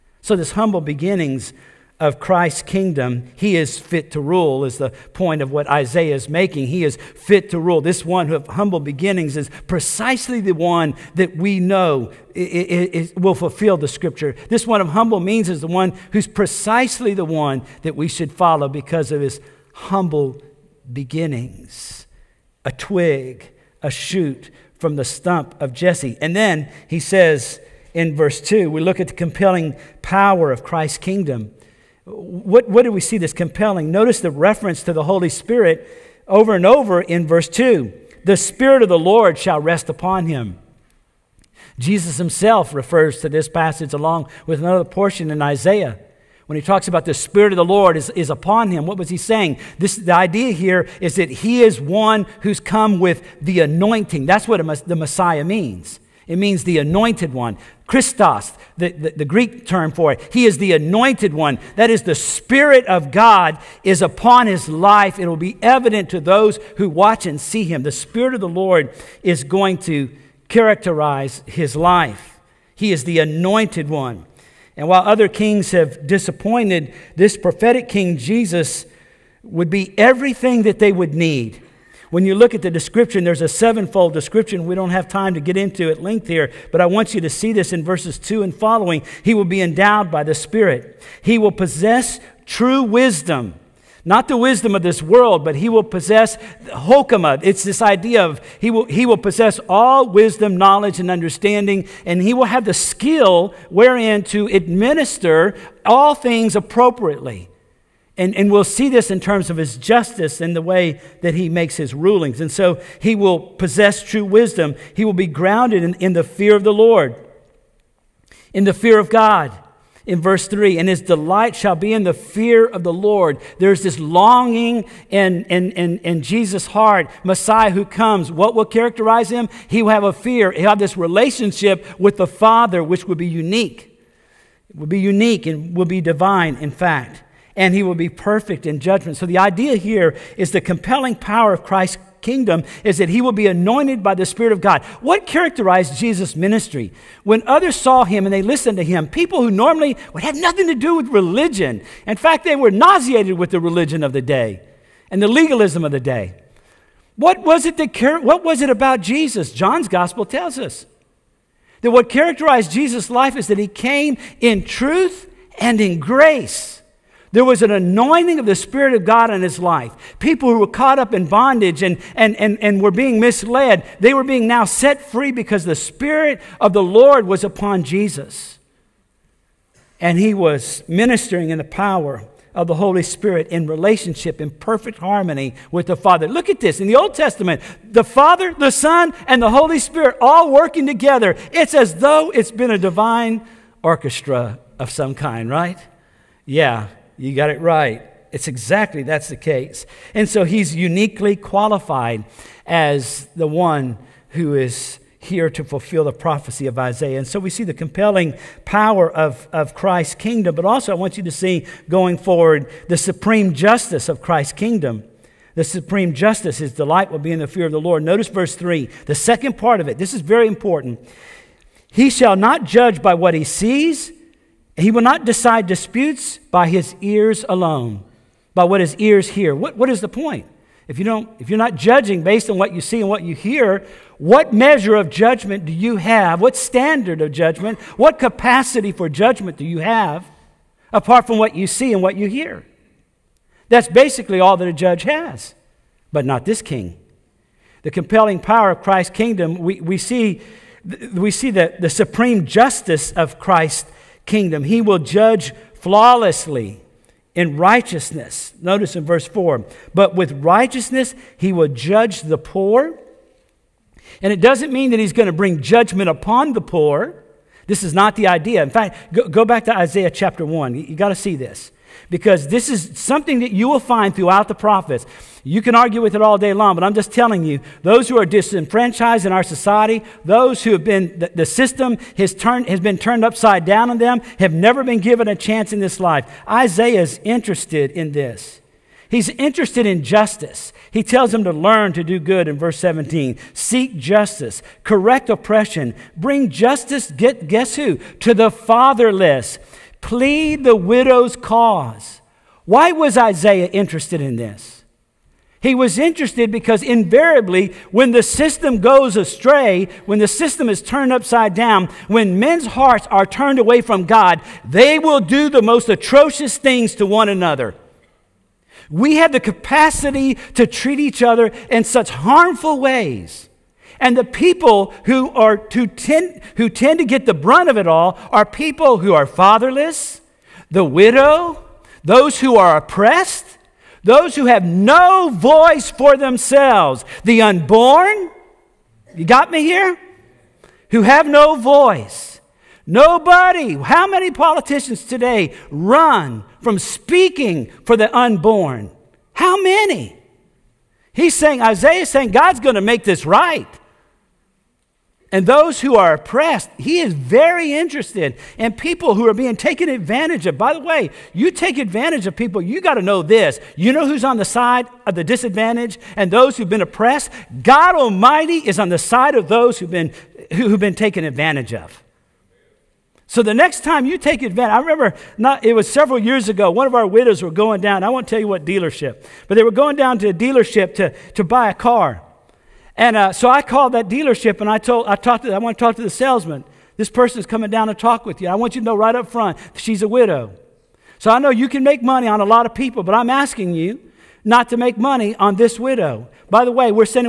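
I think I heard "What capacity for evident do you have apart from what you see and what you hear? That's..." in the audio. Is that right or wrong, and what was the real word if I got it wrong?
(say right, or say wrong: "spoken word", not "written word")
wrong: "judgment", not "evident".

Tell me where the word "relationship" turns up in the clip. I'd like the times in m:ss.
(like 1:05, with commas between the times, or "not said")
2:10, 3:03.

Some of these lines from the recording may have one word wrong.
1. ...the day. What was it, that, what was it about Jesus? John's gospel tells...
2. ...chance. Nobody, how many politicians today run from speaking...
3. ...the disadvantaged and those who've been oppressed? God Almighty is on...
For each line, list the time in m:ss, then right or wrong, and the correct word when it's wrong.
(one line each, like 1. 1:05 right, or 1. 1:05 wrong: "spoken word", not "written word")
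1. 2:35 right
2. 5:41 wrong: "voice", not "chance"
3. 6:05 right.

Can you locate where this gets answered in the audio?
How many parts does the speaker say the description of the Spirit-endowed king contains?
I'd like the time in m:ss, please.
1:23.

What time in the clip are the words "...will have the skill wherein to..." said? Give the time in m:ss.
1:42.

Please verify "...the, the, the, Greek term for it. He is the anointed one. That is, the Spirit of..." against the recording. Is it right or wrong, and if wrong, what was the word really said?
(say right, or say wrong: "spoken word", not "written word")
right.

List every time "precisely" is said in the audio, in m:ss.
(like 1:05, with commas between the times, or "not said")
0:09, 0:16.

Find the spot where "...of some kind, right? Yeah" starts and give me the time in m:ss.
3:14.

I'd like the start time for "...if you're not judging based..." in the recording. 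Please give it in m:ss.
3:51.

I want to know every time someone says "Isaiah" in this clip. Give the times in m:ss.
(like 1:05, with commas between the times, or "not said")
0:05, 0:45, 3:26, 4:29, 4:46, 5:03, 5:51.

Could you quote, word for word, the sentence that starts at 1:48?
And, and we'll see this in terms of his justice and the way that he makes his rulings.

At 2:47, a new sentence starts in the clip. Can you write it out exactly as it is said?
There was an anointing of the Spirit of God in his life.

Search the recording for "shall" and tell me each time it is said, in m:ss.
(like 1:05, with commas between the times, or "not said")
0:39, 2:01, 3:42.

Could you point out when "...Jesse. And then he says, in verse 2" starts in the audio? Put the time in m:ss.
0:25.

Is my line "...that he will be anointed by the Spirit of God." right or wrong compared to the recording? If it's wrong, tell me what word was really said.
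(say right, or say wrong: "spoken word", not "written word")
right.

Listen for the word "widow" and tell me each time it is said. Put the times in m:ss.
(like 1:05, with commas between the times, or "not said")
5:00, 5:30, 6:17, 6:30, 6:35.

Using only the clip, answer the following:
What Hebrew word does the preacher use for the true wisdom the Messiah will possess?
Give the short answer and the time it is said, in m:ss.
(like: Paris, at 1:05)
hokama, at 1:36.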